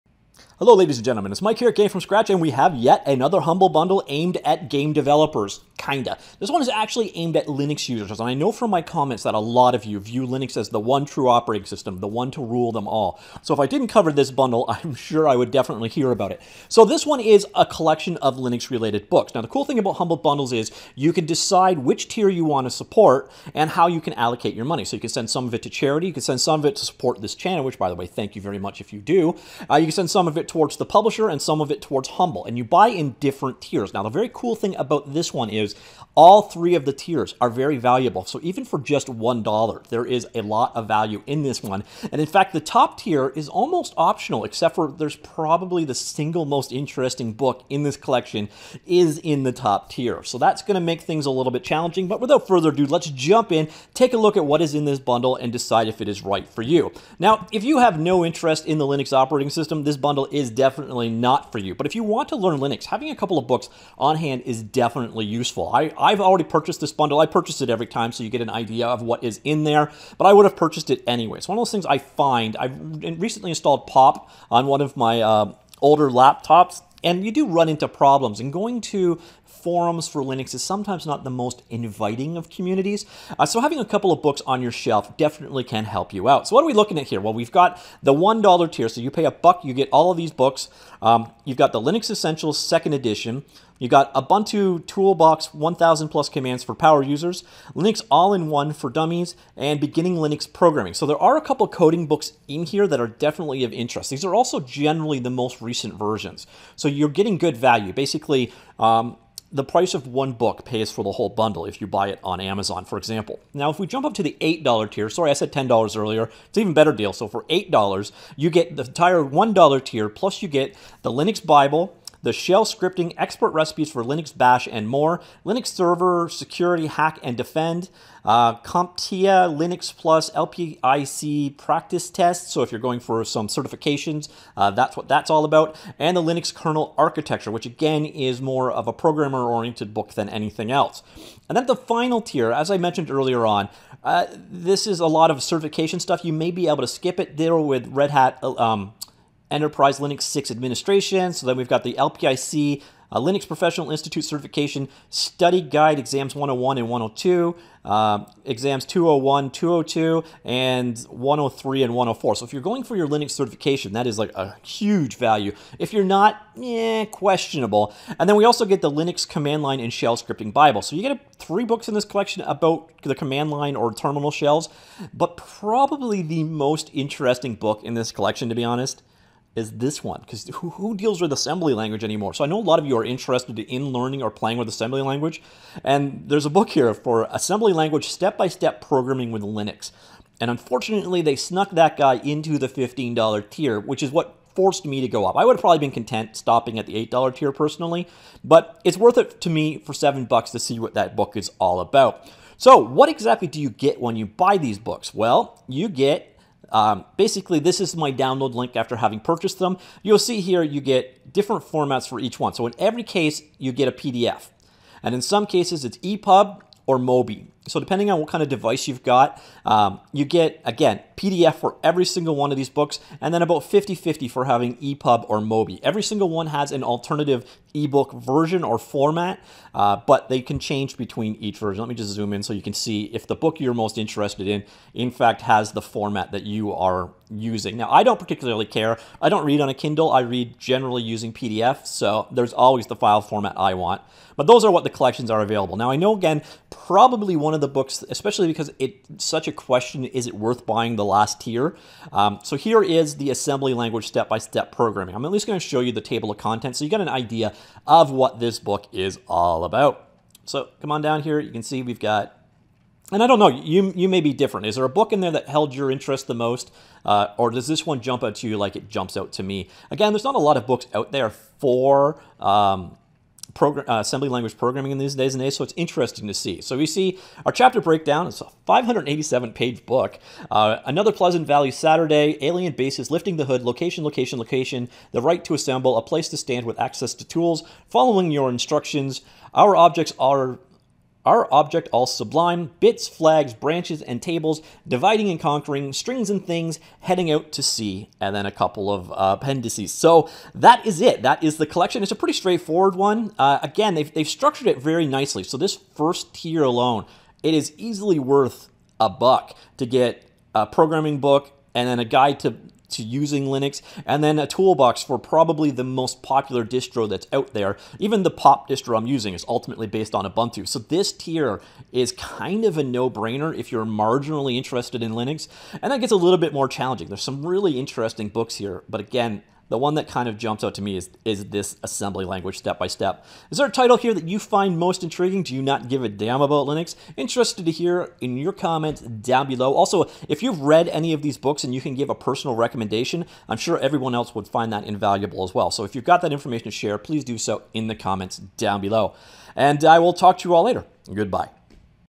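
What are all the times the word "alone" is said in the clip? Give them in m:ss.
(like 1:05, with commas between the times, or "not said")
5:06.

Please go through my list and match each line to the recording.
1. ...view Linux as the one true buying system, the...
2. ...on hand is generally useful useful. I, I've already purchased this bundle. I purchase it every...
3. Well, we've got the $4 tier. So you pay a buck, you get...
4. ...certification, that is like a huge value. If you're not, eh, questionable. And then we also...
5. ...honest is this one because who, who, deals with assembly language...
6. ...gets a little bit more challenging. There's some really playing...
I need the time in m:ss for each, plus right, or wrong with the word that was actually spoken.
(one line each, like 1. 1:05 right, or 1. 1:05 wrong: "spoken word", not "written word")
1. 0:09 wrong: "operating", not "buying"
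2. 1:03 wrong: "definitely", not "generally"
3. 1:27 wrong: "1", not "4"
4. 2:43 right
5. 2:58 right
6. 5:26 wrong: "interesting", not "playing".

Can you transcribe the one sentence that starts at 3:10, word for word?
And unfortunately, they snuck that guy into the $15 tier, which is what forced me to go up.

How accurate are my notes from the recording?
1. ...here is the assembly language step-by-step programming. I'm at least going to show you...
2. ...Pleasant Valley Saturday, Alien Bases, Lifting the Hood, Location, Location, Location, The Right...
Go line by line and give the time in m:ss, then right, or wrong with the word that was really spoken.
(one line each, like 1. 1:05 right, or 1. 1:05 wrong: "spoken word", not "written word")
1. 4:12 right
2. 4:41 right.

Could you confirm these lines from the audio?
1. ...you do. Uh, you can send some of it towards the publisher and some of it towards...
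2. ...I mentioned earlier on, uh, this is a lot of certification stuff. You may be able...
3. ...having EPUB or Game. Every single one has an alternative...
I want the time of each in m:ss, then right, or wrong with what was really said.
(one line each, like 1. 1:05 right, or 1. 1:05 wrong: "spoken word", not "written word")
1. 0:28 right
2. 2:22 right
3. 3:44 wrong: "MOBI", not "Game".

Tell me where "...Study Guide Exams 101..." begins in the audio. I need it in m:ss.
2:35.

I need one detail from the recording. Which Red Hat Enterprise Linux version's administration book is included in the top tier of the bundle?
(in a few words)
6.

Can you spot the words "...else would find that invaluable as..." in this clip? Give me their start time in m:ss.
5:44.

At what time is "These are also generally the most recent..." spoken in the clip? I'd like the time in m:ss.
1:44.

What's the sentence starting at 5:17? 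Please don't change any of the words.
Even the pop distro I'm using is ultimately based on Ubuntu.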